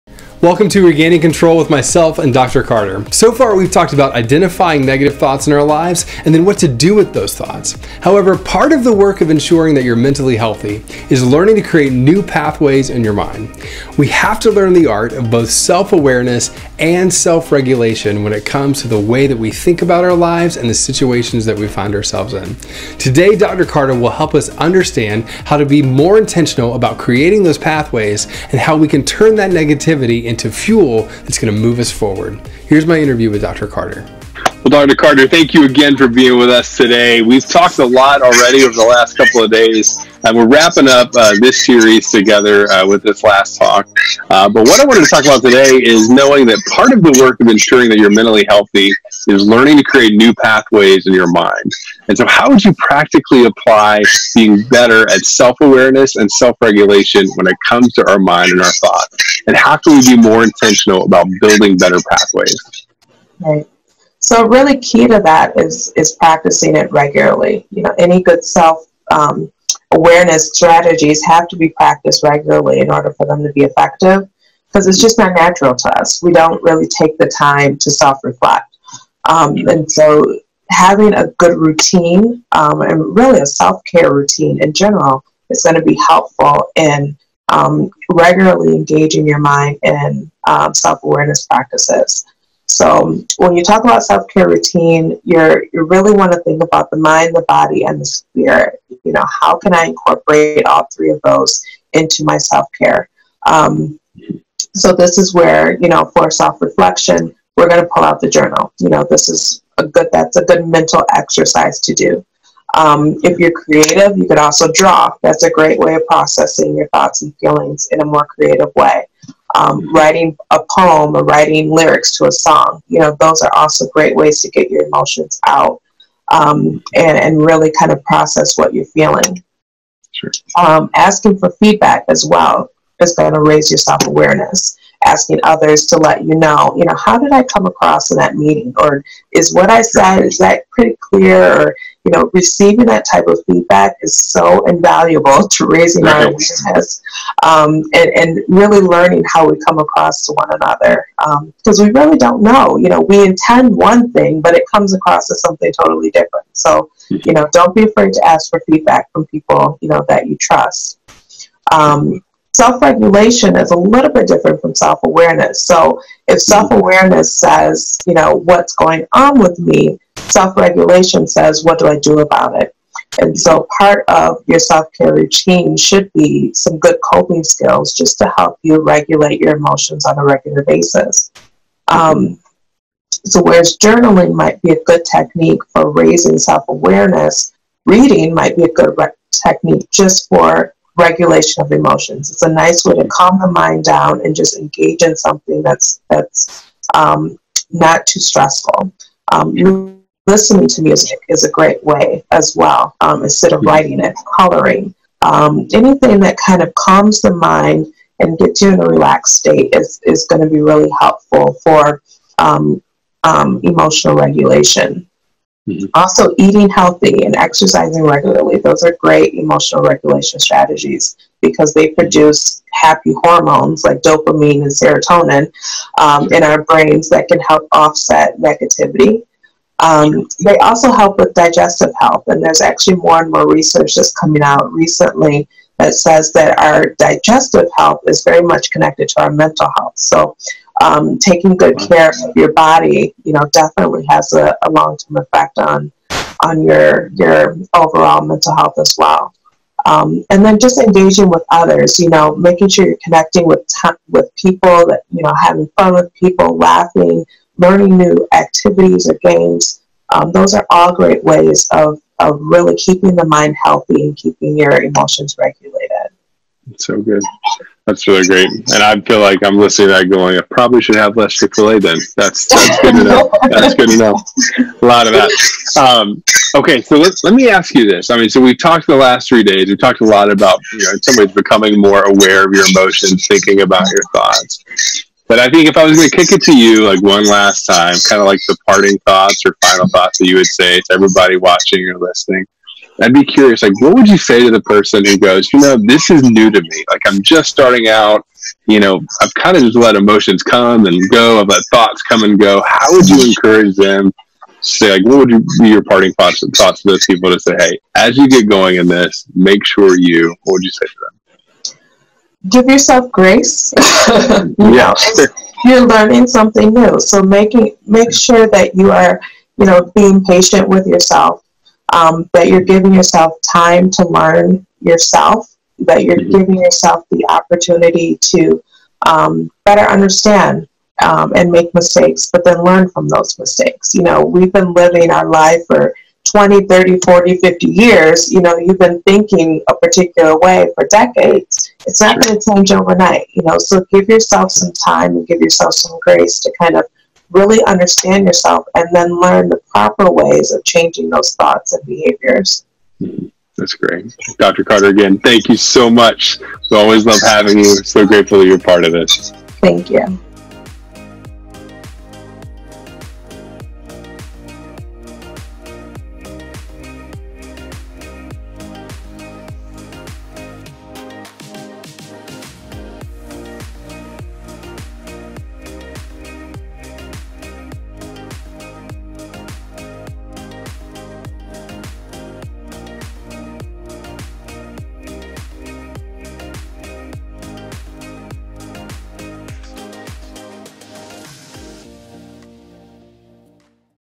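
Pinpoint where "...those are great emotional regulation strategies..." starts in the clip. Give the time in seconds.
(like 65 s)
218 s.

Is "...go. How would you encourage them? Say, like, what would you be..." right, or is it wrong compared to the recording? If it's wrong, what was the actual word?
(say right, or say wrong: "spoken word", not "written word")
right.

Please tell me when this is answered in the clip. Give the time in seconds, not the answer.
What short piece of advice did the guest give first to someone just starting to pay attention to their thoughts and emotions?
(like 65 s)
312 s.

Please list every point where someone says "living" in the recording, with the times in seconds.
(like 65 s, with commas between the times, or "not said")
334 s.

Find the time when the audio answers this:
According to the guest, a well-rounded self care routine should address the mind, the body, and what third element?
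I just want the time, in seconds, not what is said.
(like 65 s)
97 s.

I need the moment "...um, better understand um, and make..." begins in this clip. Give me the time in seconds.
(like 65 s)
329 s.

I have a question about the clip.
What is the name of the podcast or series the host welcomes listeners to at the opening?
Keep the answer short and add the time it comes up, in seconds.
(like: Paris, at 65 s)
Regaining Control, at 0 s.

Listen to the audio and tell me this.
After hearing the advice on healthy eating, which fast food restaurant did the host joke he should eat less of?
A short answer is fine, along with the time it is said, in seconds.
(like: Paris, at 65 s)
Chick fil A, at 271 s.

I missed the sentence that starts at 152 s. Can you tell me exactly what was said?
You know, we intend one thing, but it comes across as something totally different.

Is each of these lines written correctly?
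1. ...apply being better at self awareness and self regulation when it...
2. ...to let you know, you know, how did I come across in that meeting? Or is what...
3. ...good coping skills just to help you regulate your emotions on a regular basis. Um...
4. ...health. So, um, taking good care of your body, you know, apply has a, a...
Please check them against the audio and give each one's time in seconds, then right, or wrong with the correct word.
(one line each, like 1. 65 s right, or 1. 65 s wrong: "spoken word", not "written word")
1. 53 s right
2. 135 s right
3. 176 s right
4. 239 s wrong: "definitely", not "apply".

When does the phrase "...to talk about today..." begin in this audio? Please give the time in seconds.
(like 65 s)
45 s.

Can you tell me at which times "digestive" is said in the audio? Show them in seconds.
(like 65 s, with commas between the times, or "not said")
231 s, 236 s.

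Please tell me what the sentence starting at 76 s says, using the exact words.
We don't really take the time to self reflect.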